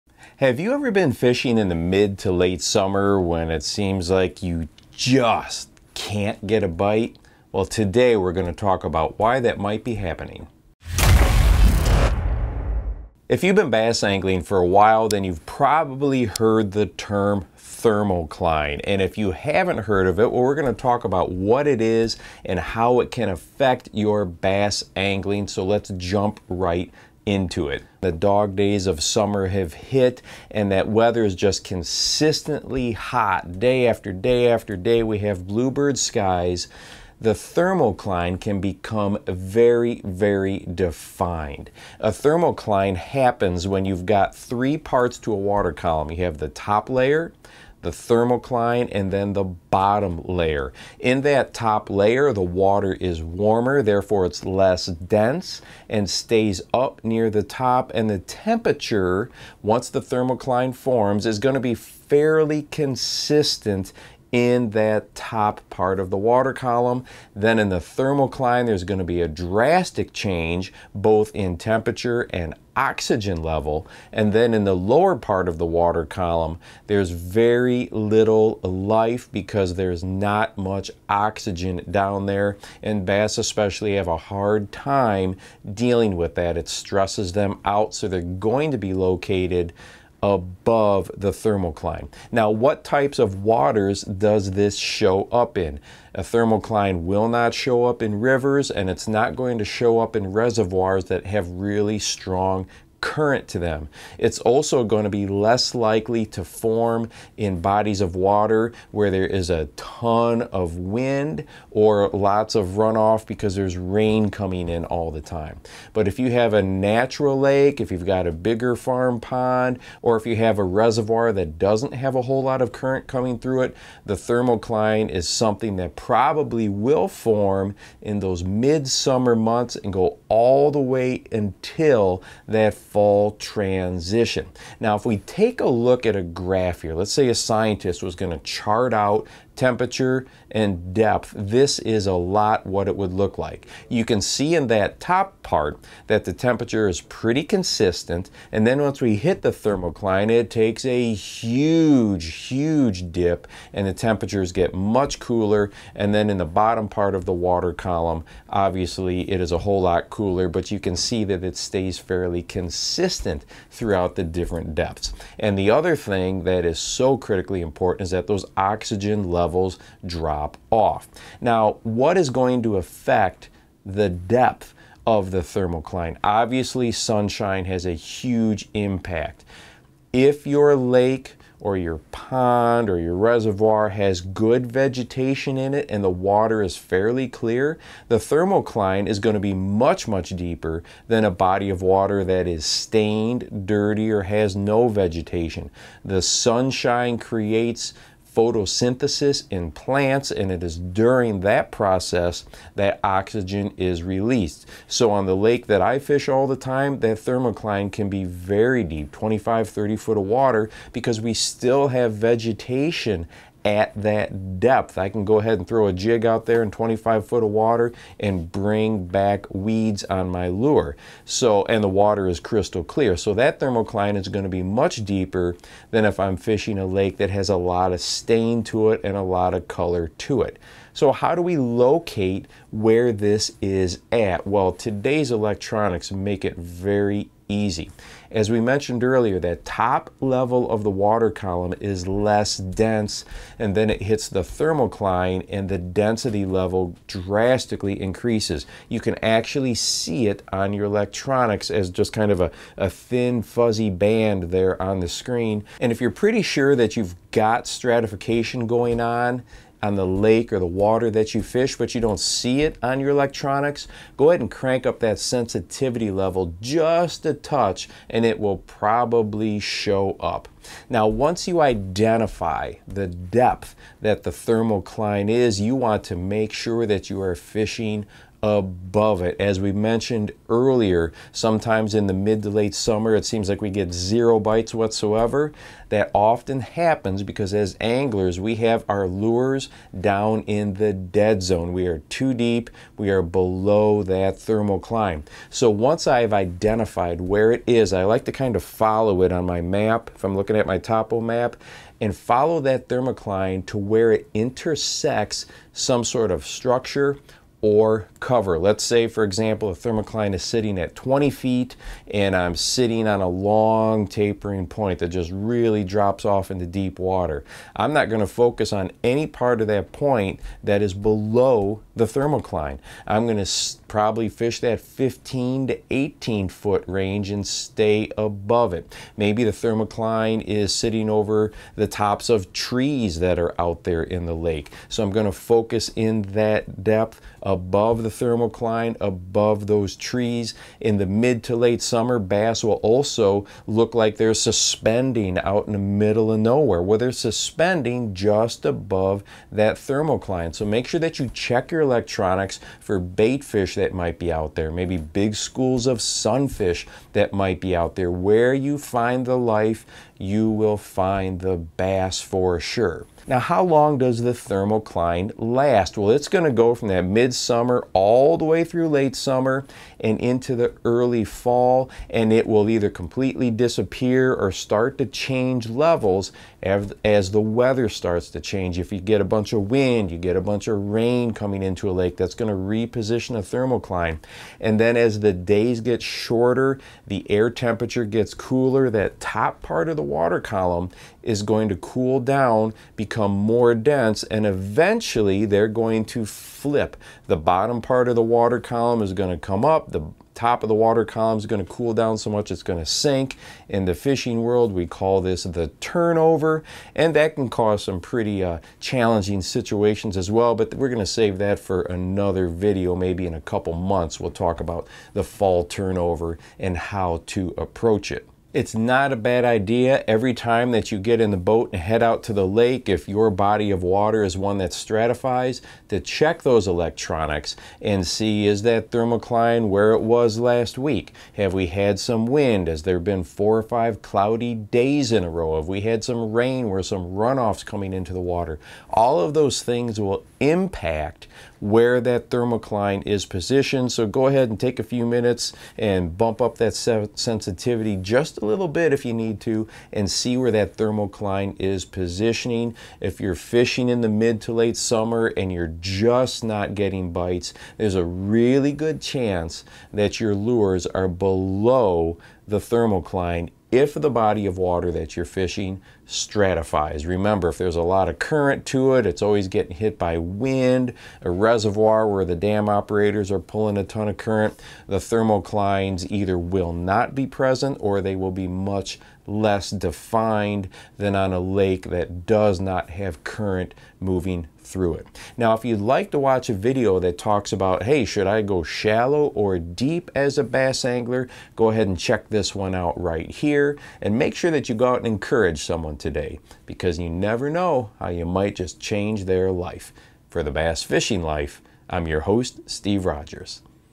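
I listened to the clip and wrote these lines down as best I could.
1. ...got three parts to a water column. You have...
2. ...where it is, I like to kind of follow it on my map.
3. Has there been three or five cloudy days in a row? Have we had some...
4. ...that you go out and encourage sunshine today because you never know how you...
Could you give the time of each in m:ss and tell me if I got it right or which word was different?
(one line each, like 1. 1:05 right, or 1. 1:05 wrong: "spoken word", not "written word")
1. 0:44 right
2. 4:57 right
3. 7:12 wrong: "four", not "three"
4. 8:14 wrong: "someone", not "sunshine".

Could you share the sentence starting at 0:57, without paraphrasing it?
And the temperature, once the thermocline forms, is going to be fairly consistent in that top part of the water column.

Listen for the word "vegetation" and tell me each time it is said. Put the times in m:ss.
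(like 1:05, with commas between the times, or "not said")
3:04, 3:14, 3:32.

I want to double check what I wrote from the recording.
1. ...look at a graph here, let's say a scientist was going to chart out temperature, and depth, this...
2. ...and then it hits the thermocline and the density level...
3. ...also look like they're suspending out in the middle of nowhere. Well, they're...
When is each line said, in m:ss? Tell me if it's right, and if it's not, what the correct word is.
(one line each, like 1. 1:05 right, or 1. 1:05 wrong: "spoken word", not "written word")
1. 2:15 right
2. 4:03 right
3. 5:42 right.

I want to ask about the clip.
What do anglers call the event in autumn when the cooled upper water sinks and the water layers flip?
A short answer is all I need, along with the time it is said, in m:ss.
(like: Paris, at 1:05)
the turnover, at 6:45.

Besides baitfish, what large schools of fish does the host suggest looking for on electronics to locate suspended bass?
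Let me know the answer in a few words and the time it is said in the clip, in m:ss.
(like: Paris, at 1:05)
sunfish, at 5:56.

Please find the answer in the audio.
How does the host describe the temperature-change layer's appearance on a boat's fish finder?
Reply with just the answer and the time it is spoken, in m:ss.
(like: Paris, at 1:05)
thin fuzzy band, at 4:12.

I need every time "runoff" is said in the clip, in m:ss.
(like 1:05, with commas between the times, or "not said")
1:52, 7:17.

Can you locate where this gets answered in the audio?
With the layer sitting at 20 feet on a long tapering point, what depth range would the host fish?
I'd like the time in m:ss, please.
5:24.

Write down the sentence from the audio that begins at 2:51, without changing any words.
Now, what is going to affect the depth of the thermocline?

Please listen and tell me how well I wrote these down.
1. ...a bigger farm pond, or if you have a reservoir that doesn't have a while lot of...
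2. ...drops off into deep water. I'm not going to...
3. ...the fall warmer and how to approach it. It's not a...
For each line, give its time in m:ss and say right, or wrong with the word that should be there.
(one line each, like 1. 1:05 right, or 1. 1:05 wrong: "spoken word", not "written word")
1. 1:58 wrong: "whole", not "while"
2. 5:15 right
3. 6:55 wrong: "turnover", not "warmer".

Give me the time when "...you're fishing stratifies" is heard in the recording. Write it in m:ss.
7:45.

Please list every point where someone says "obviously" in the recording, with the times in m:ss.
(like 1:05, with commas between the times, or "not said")
2:38, 2:56.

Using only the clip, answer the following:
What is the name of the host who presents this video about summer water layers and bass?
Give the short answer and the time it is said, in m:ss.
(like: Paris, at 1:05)
Steve Rogers, at 8:22.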